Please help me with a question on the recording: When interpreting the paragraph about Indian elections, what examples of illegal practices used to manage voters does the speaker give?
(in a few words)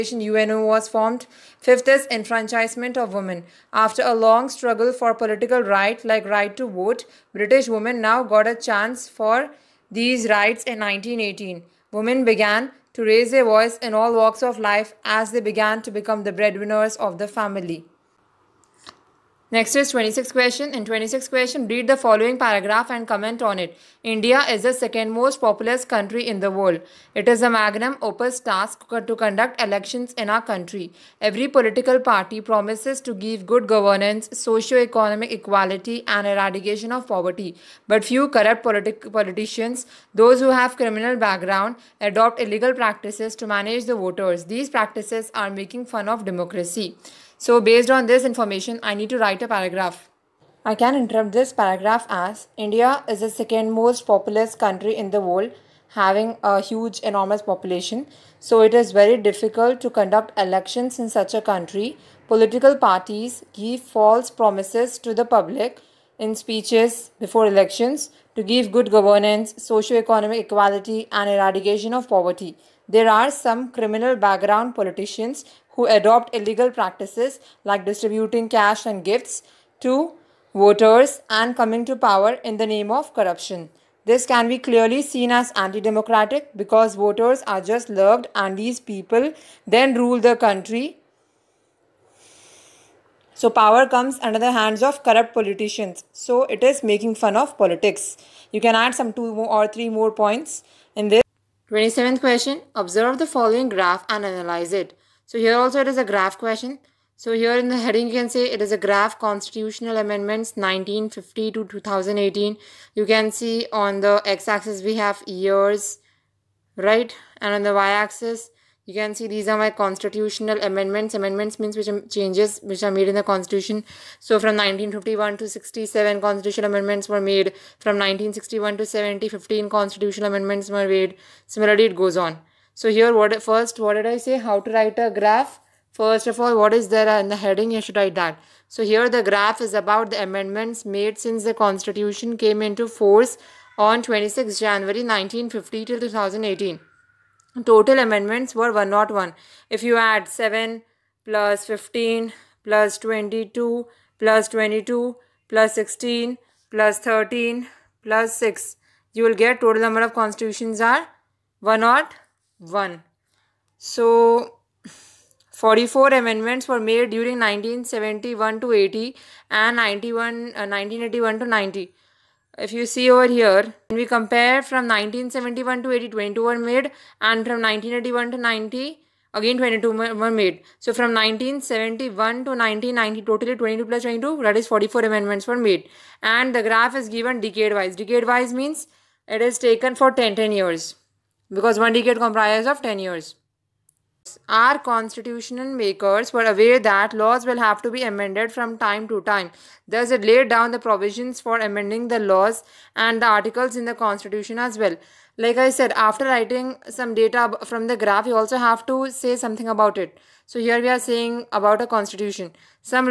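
distributing cash and gifts.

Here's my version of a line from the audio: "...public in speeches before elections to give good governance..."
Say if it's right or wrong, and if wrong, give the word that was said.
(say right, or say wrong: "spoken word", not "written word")
right.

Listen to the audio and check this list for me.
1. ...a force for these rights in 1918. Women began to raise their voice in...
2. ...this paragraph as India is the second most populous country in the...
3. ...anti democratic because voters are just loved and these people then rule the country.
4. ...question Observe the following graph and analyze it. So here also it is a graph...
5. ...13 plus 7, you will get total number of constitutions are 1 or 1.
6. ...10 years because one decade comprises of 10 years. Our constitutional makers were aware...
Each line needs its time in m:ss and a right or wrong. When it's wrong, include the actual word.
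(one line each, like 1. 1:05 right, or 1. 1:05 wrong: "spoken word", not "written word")
1. 0:08 wrong: "chance", not "force"
2. 0:51 right
3. 1:25 right
4. 1:42 right
5. 2:36 wrong: "6", not "7"
6. 3:10 right.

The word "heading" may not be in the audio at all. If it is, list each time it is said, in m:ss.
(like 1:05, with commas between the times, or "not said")
1:47, 2:17.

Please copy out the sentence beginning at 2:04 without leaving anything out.
So from 1951 to 67 constitutional amendments were made.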